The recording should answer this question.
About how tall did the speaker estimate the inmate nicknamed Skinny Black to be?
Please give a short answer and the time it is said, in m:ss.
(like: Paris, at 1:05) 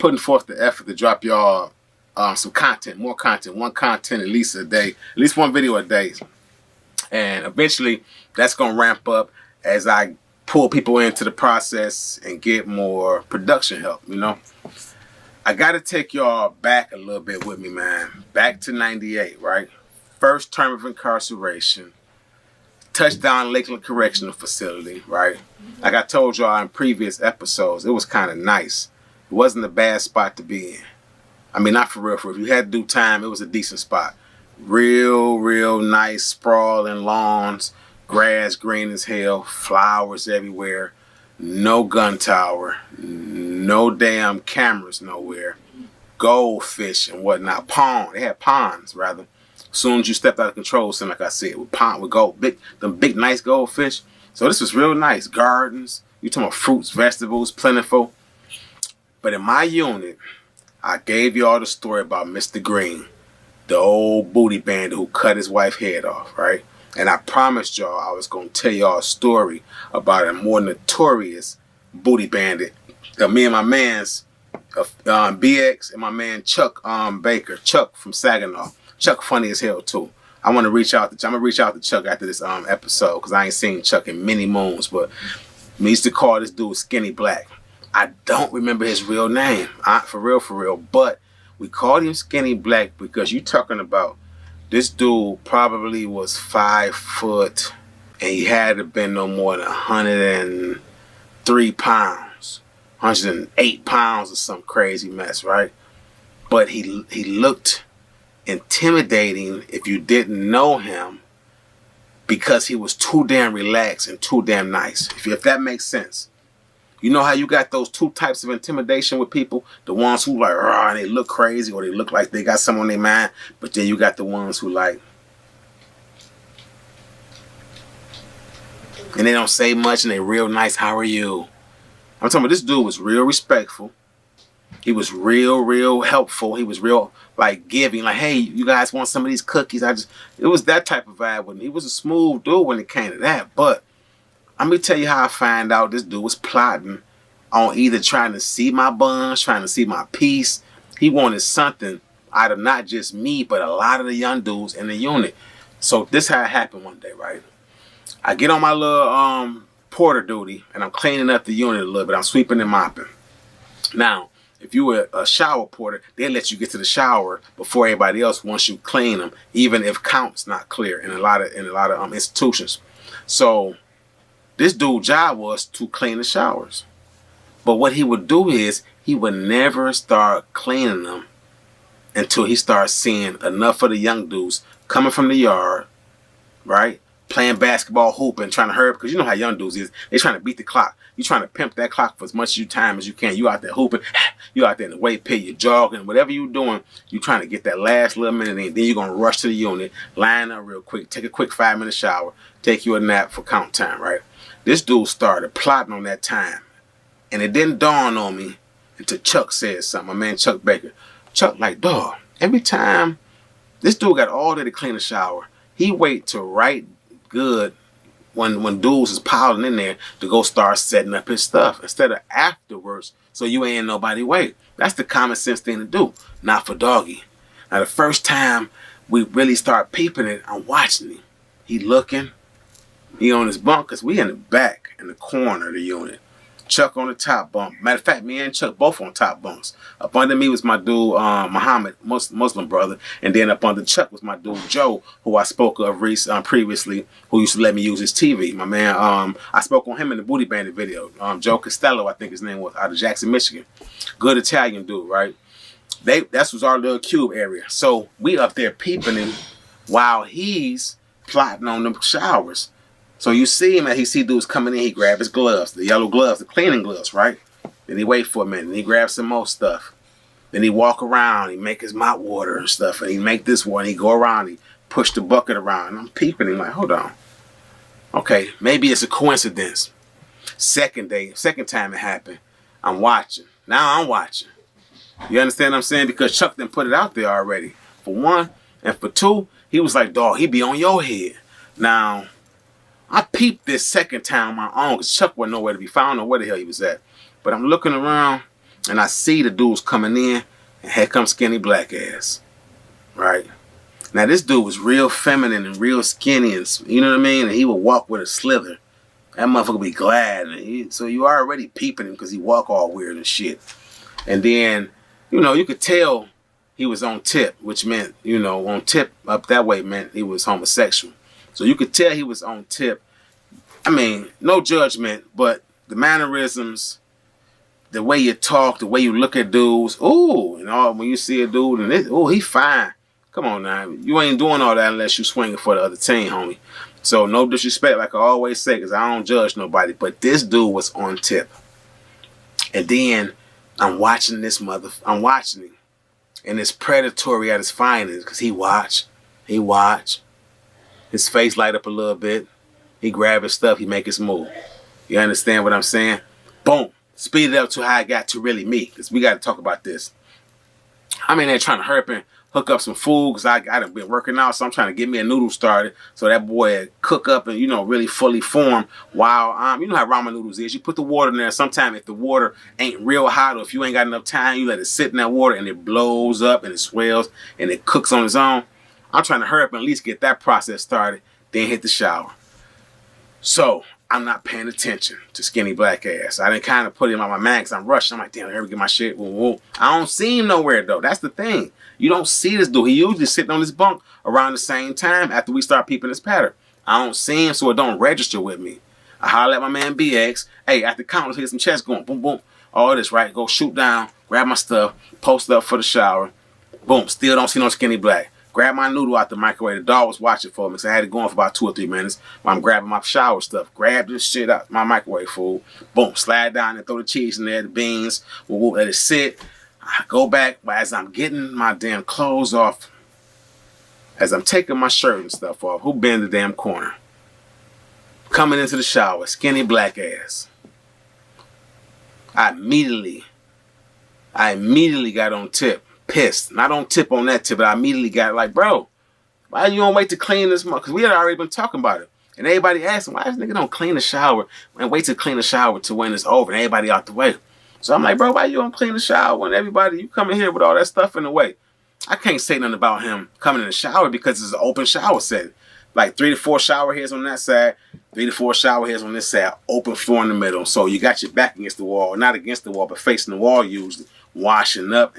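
5 foot, at 1:36.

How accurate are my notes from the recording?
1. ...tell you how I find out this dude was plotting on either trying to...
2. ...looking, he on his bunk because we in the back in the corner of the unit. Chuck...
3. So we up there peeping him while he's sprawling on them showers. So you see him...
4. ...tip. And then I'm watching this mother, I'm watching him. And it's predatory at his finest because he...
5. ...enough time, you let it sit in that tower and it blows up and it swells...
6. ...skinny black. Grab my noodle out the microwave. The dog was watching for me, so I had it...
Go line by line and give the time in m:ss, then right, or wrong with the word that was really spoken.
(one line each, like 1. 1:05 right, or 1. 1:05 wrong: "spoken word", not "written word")
1. 2:24 right
2. 3:51 right
3. 4:17 wrong: "plotting", not "sprawling"
4. 5:41 right
5. 6:14 wrong: "water", not "tower"
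6. 6:47 right.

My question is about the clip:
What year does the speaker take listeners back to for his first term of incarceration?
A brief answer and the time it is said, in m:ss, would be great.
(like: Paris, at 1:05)
1998, at 0:18.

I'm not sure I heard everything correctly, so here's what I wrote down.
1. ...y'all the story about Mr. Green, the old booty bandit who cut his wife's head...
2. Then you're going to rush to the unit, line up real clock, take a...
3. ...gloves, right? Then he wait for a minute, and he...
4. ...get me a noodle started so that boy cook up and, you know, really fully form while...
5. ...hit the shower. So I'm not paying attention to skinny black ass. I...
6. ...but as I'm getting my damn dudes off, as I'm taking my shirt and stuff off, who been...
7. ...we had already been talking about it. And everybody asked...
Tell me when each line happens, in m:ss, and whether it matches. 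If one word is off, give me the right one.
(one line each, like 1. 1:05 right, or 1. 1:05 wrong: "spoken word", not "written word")
1. 1:01 right
2. 3:18 wrong: "quick", not "clock"
3. 4:26 right
4. 6:04 right
5. 6:21 right
6. 7:00 wrong: "clothes", not "dudes"
7. 7:20 right.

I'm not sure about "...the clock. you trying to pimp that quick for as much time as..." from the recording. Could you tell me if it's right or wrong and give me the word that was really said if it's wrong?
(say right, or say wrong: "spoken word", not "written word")
wrong: "clock", not "quick".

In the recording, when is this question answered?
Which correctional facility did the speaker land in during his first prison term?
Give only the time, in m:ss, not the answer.
0:23.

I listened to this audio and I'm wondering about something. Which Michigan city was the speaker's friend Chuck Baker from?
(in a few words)
Saginaw.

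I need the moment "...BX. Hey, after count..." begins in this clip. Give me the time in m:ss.
6:39.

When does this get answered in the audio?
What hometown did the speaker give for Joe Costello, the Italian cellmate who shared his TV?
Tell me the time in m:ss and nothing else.
4:12.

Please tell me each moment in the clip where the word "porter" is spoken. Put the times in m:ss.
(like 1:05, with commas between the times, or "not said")
2:39, 2:45.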